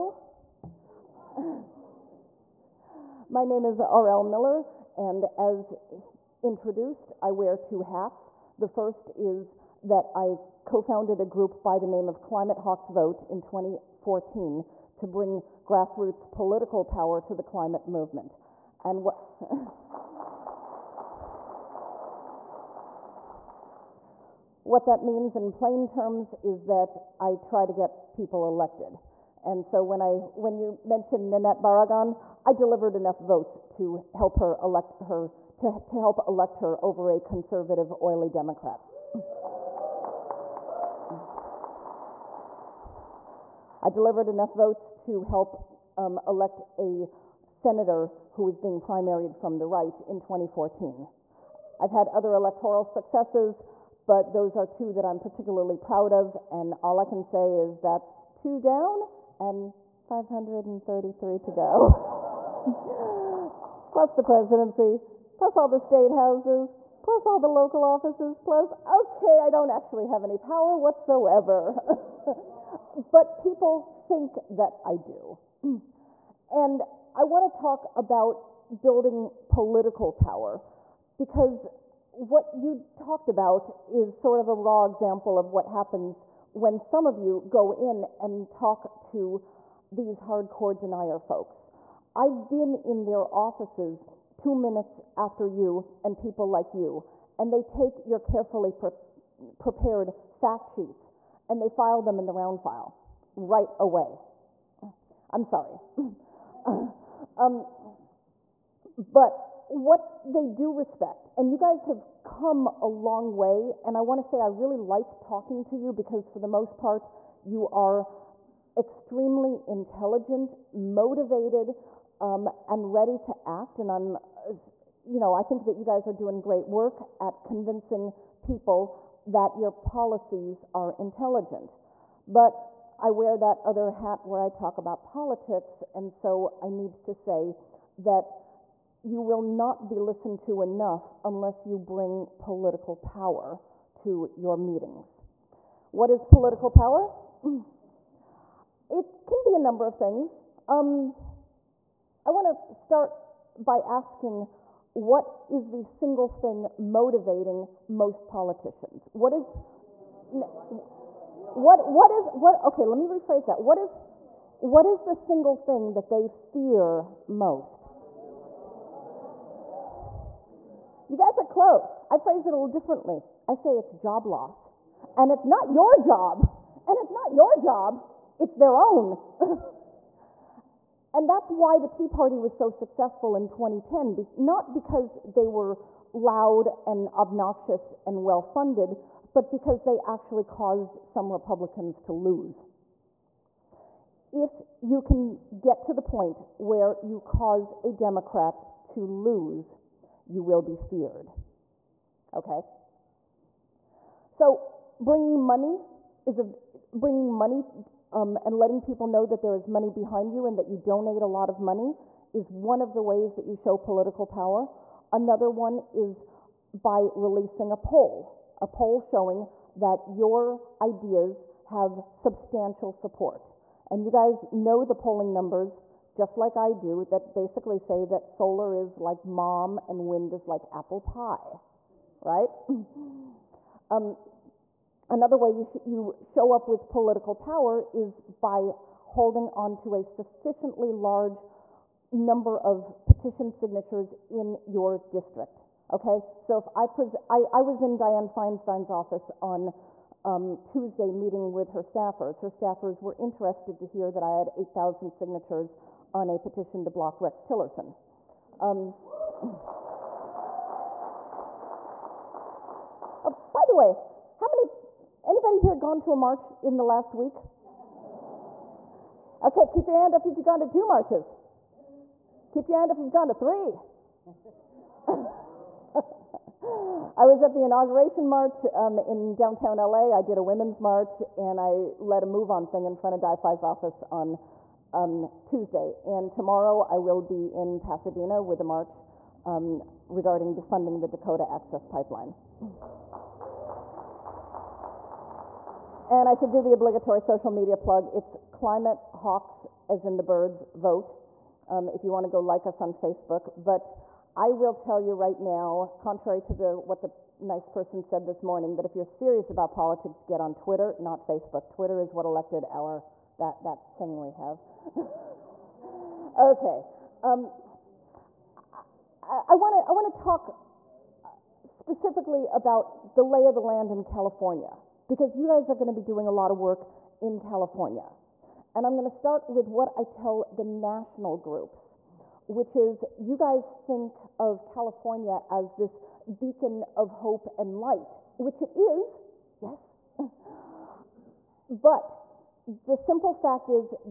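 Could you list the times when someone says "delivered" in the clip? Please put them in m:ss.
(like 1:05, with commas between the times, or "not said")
0:32, 0:43.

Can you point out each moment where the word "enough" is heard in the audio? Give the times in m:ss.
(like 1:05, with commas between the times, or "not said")
0:32, 0:44, 2:20.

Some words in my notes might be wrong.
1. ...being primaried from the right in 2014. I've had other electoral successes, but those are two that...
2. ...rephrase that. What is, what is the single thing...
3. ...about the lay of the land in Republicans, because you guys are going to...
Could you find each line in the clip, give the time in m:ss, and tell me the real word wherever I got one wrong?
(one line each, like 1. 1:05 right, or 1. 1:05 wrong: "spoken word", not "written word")
1. 0:48 right
2. 2:43 right
3. 5:22 wrong: "California", not "Republicans".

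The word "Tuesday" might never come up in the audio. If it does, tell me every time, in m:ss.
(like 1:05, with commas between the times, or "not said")
4:10, 4:45.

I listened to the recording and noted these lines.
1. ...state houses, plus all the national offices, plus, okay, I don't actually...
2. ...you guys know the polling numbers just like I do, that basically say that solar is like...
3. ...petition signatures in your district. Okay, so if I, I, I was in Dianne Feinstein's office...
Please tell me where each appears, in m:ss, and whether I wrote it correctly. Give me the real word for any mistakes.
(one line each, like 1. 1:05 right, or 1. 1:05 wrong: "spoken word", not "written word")
1. 1:05 wrong: "local", not "national"
2. 3:44 right
3. 4:03 right.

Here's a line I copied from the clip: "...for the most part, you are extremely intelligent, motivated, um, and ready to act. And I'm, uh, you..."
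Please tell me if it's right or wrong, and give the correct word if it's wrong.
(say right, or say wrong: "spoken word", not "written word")
right.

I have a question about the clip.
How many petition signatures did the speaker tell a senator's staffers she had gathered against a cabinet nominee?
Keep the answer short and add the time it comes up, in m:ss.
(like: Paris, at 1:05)
8,000, at 4:14.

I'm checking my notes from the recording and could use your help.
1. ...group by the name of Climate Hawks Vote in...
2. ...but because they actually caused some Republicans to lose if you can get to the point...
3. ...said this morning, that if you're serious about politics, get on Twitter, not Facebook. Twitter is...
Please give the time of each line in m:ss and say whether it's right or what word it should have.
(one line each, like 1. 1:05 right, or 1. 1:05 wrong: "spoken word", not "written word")
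1. 0:11 right
2. 3:09 right
3. 5:08 right.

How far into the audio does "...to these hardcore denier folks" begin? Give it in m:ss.
1:28.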